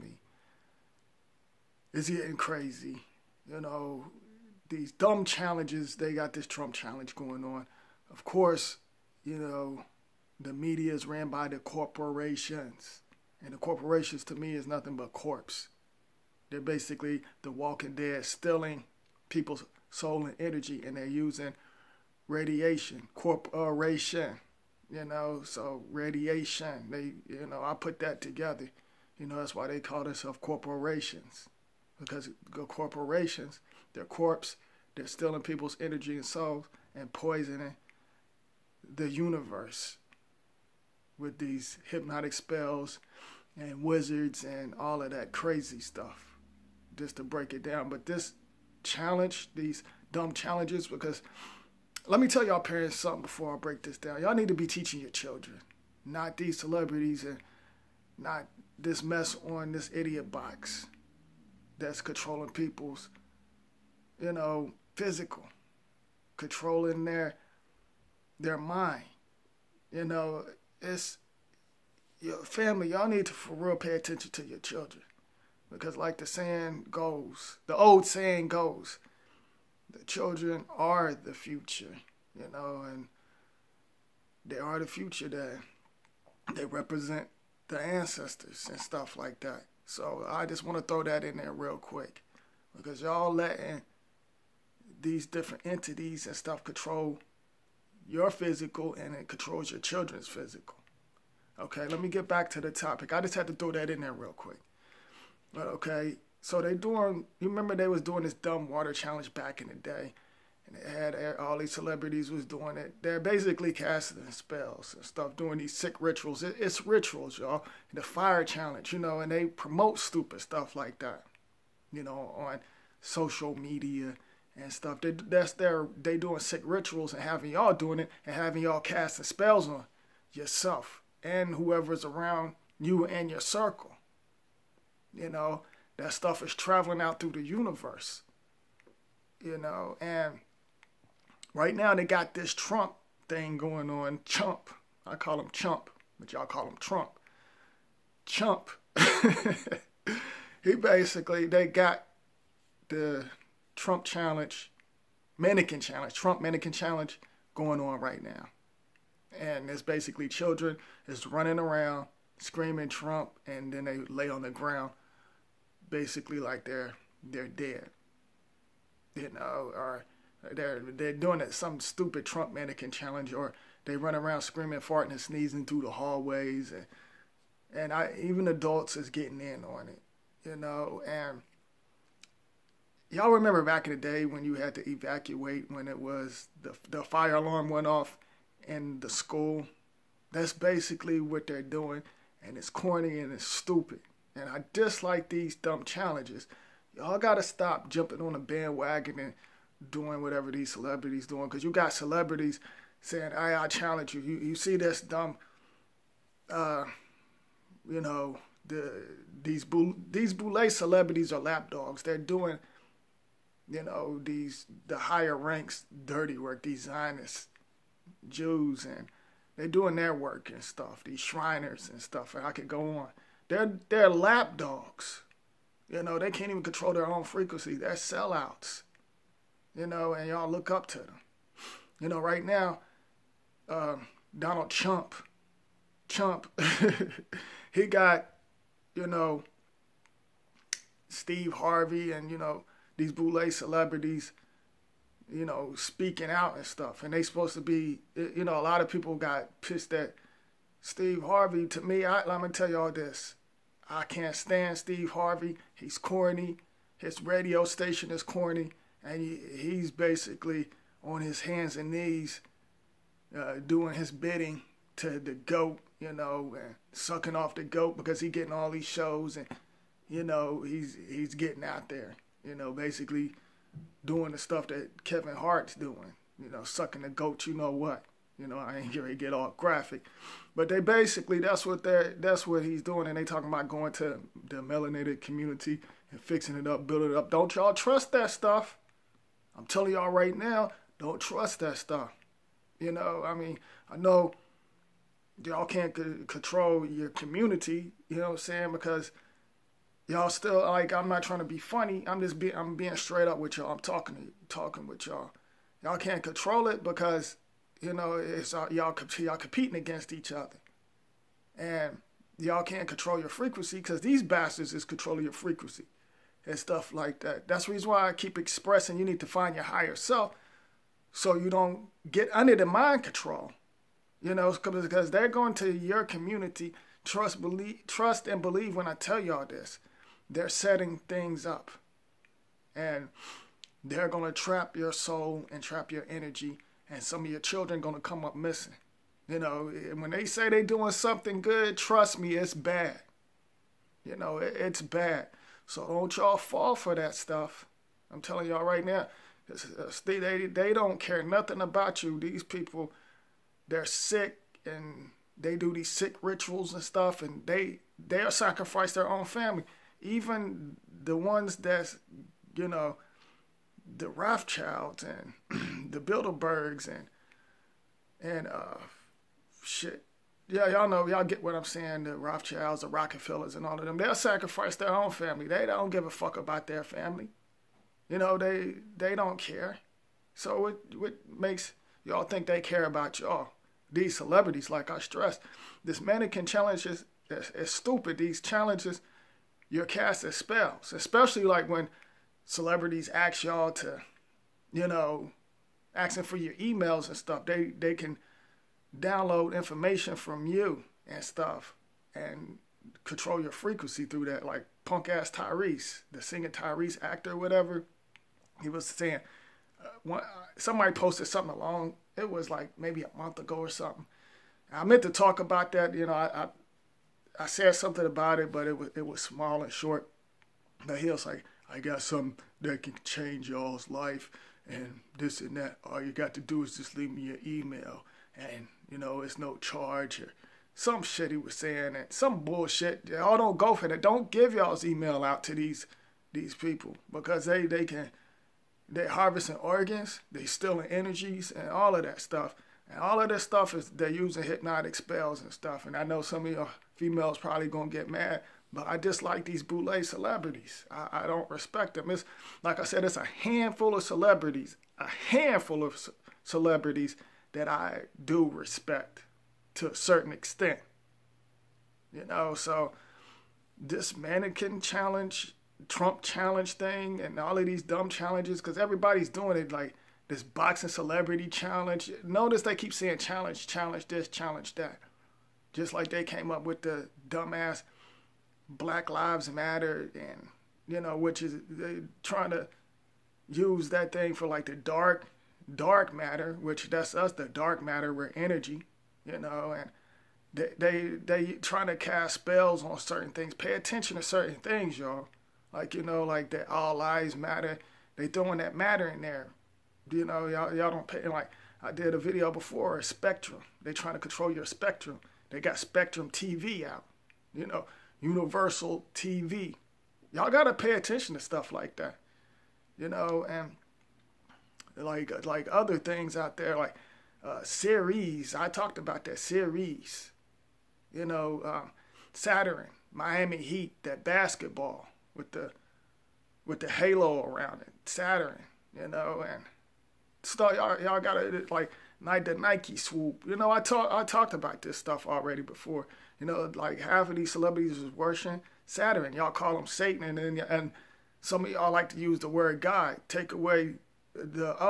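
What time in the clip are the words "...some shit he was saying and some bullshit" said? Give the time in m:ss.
7:10.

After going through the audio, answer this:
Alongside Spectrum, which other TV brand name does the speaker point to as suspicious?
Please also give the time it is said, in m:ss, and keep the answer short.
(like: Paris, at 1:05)
Universal TV, at 8:28.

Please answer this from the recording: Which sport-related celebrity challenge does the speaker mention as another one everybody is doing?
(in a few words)
boxing celebrity challenge.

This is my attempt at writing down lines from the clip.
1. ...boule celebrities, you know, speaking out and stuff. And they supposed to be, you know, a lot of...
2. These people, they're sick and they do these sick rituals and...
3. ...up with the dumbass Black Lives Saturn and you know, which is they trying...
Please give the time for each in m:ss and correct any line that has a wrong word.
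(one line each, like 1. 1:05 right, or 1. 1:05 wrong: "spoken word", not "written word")
1. 4:03 right
2. 5:52 right
3. 7:56 wrong: "Matter", not "Saturn".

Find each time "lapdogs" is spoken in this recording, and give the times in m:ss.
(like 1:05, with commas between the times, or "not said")
3:31, 3:44.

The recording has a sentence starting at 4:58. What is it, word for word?
Because y'all still like I'm not trying to be funny.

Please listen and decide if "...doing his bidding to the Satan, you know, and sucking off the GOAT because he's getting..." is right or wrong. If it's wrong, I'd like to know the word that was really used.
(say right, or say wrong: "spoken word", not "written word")
wrong: "GOAT", not "Satan".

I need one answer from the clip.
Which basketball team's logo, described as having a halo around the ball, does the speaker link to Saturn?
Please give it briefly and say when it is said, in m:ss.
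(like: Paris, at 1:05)
Miami Heat, at 8:43.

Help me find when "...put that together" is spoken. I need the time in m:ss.
0:27.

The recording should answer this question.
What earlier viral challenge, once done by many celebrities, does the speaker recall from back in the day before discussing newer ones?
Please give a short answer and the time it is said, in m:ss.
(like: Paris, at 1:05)
water challenge, at 1:48.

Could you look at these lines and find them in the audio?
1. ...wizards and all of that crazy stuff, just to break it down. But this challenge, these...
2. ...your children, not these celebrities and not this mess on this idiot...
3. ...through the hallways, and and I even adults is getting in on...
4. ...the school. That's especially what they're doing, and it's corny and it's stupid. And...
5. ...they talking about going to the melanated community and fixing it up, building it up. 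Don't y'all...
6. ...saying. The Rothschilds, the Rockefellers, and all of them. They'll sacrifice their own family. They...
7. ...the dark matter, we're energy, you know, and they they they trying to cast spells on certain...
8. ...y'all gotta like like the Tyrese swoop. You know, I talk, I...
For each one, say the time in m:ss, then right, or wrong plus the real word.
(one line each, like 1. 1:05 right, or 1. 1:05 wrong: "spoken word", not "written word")
1. 0:43 right
2. 0:55 right
3. 2:55 right
4. 3:09 wrong: "basically", not "especially"
5. 4:43 right
6. 6:11 right
7. 8:07 right
8. 8:51 wrong: "Nike", not "Tyrese".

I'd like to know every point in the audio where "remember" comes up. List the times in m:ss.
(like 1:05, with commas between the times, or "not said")
1:47, 3:03.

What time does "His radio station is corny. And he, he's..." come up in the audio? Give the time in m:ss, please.
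4:16.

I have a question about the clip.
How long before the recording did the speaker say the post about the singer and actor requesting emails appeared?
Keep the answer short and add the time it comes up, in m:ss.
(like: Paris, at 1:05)
a month ago, at 6:53.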